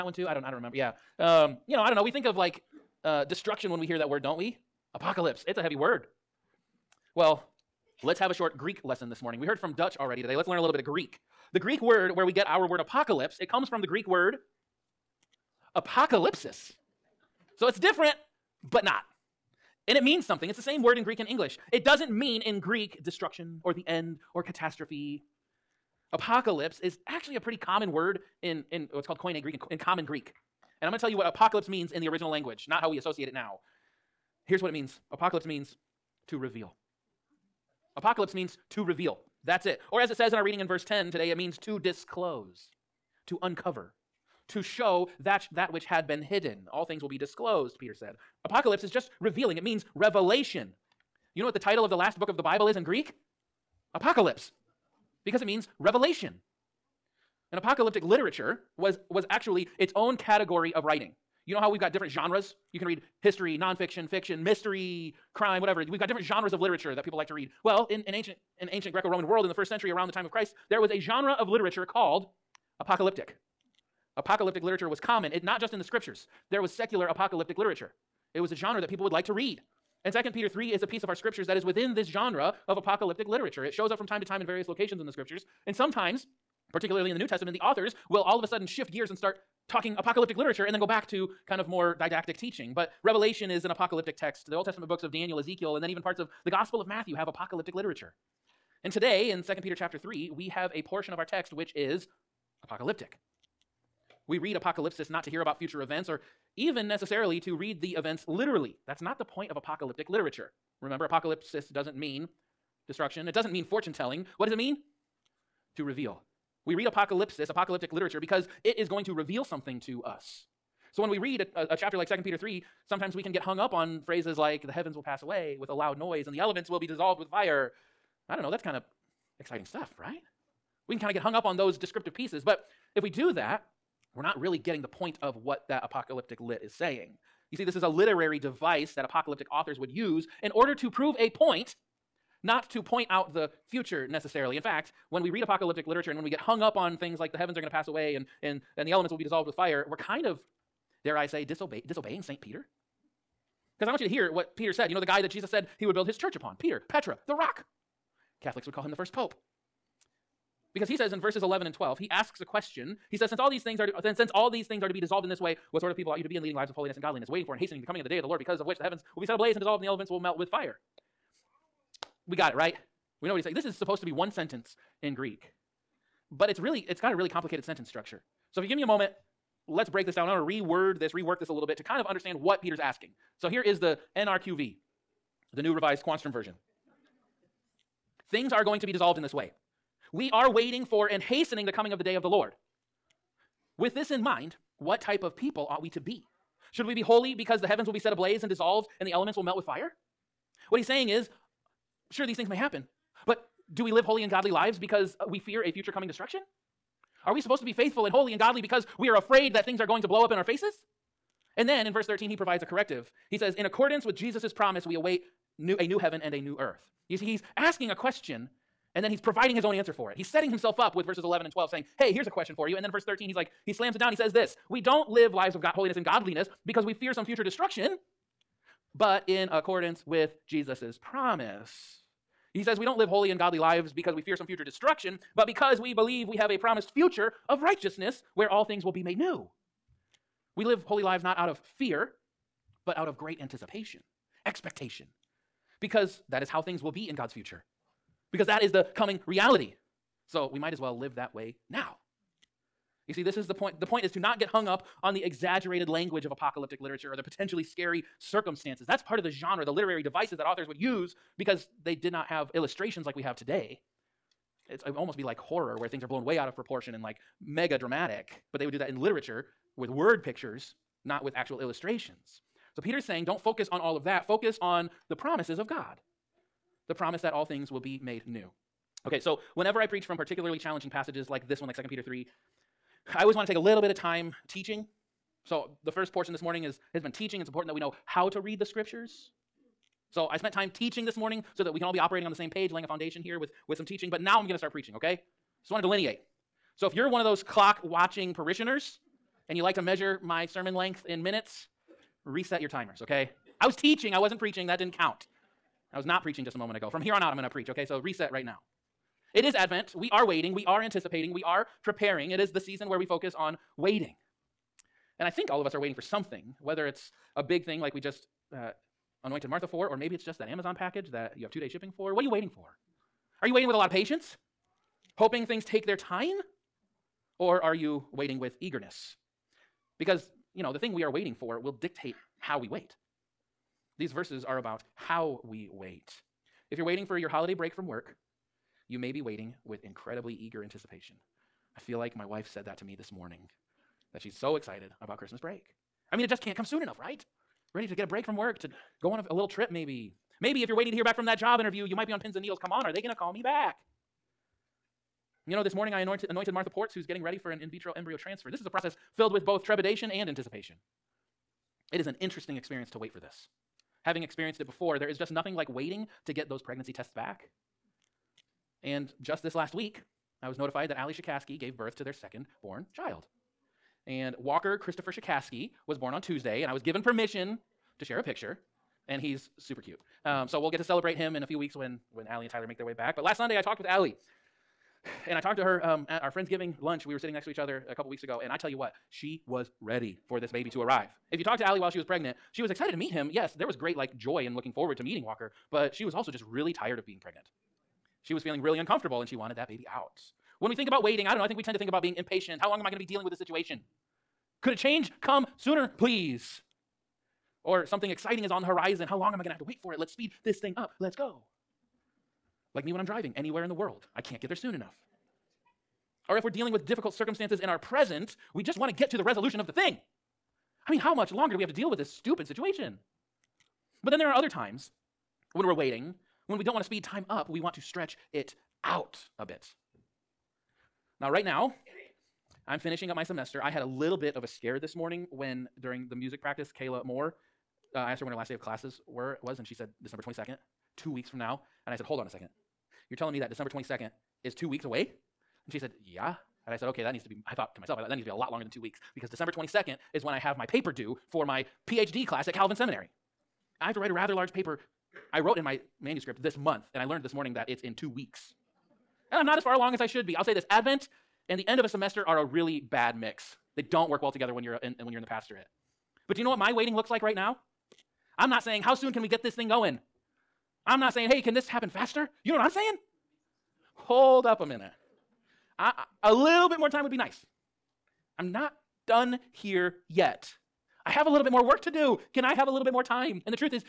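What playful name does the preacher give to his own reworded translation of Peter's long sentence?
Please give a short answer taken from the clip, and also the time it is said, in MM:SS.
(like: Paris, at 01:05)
the new revised Quanstrom version, at 03:05.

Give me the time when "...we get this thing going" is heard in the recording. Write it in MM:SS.
07:49.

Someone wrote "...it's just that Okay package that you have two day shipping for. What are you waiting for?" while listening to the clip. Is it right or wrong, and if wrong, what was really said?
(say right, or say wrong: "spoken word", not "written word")
wrong: "Amazon", not "Okay".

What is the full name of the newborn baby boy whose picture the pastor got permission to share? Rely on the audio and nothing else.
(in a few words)
Walker Christopher Shikaski.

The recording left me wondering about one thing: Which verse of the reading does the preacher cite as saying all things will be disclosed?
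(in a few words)
verse 10.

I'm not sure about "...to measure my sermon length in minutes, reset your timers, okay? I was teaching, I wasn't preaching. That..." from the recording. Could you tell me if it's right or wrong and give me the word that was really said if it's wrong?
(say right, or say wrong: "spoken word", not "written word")
right.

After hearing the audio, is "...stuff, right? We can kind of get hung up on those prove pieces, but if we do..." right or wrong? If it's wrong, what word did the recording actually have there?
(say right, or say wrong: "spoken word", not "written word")
wrong: "descriptive", not "prove".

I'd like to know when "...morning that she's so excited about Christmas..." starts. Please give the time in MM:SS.
05:43.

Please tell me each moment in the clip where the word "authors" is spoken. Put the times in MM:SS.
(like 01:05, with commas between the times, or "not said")
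01:27, 02:19, 04:20.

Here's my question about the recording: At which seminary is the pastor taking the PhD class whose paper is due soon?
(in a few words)
Calvin Seminary.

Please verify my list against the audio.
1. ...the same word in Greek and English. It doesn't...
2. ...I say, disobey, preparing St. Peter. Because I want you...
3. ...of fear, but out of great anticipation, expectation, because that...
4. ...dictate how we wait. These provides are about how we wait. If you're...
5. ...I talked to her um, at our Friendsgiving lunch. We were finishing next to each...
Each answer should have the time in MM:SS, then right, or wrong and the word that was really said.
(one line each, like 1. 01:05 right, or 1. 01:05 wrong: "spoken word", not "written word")
1. 00:20 right
2. 02:31 wrong: "disobeying", not "preparing"
3. 04:01 right
4. 05:31 wrong: "verses", not "provides"
5. 06:25 wrong: "sitting", not "finishing".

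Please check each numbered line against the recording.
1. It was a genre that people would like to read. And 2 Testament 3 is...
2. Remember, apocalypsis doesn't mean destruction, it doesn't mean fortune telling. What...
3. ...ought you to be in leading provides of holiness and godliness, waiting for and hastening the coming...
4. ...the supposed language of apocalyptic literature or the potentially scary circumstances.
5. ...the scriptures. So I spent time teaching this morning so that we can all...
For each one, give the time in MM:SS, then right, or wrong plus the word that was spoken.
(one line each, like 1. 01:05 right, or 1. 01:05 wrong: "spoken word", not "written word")
1. 01:18 wrong: "Peter", not "Testament"
2. 01:50 right
3. 02:46 wrong: "lives", not "provides"
4. 04:15 wrong: "exaggerated", not "supposed"
5. 04:48 right.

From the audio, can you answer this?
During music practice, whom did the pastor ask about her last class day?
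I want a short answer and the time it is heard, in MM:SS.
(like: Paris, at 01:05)
Kayla Moore, at 07:16.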